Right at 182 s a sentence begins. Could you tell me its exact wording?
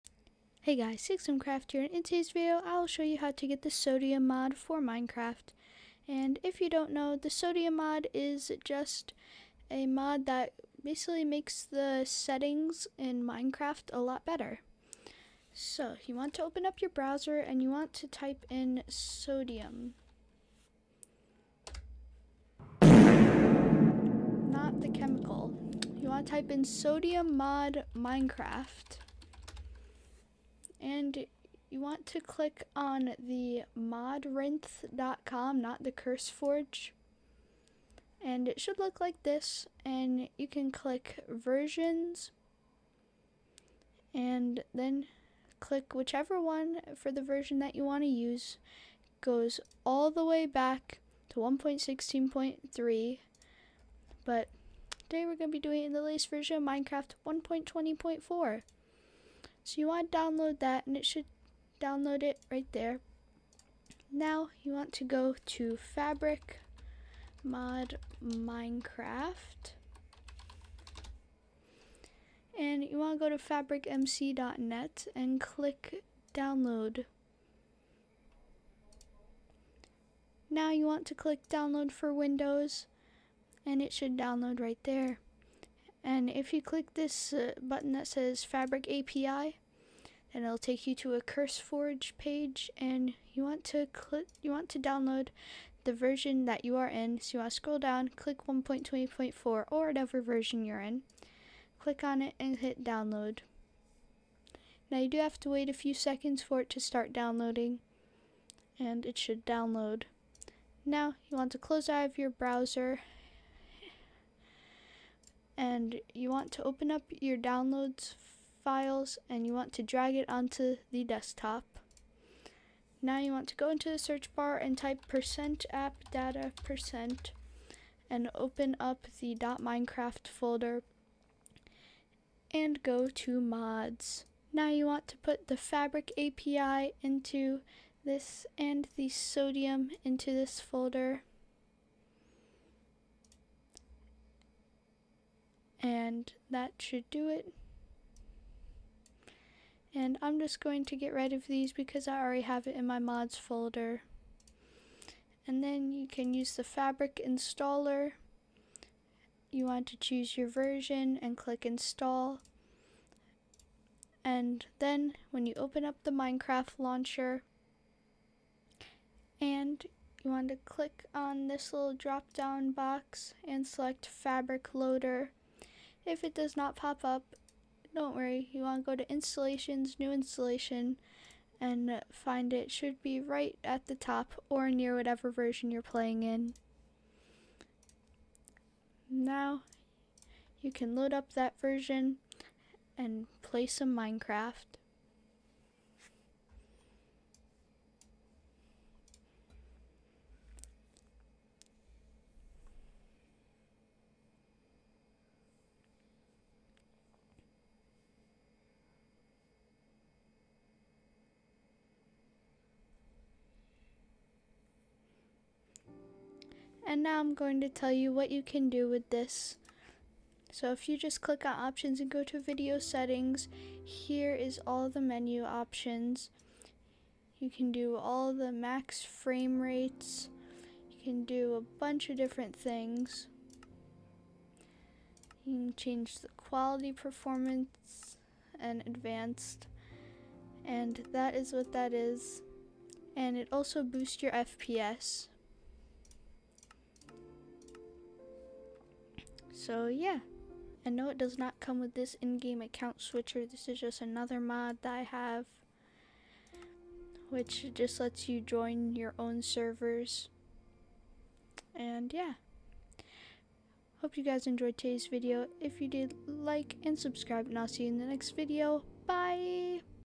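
Should be right at the top or near whatever version you're playing in.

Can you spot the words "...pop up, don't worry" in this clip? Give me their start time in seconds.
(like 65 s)
176 s.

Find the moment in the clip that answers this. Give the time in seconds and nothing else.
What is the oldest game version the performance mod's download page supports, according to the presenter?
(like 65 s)
51 s.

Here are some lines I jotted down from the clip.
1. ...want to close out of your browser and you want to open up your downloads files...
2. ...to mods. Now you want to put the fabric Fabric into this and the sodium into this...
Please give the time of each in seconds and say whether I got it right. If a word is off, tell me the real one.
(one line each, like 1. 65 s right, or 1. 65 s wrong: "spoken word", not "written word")
1. 111 s right
2. 133 s wrong: "API", not "Fabric".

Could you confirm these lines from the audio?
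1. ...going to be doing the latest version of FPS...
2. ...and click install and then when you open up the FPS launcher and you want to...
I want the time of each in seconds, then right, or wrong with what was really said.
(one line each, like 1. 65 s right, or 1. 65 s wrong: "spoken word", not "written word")
1. 55 s wrong: "Minecraft", not "FPS"
2. 161 s wrong: "Minecraft", not "FPS".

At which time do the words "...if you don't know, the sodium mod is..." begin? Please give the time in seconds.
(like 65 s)
6 s.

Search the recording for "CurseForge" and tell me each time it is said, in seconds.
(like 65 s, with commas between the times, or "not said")
35 s, 91 s.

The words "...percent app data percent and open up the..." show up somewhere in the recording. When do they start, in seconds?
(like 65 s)
125 s.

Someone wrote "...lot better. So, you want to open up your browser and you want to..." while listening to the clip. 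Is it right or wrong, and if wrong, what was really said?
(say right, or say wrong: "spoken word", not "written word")
right.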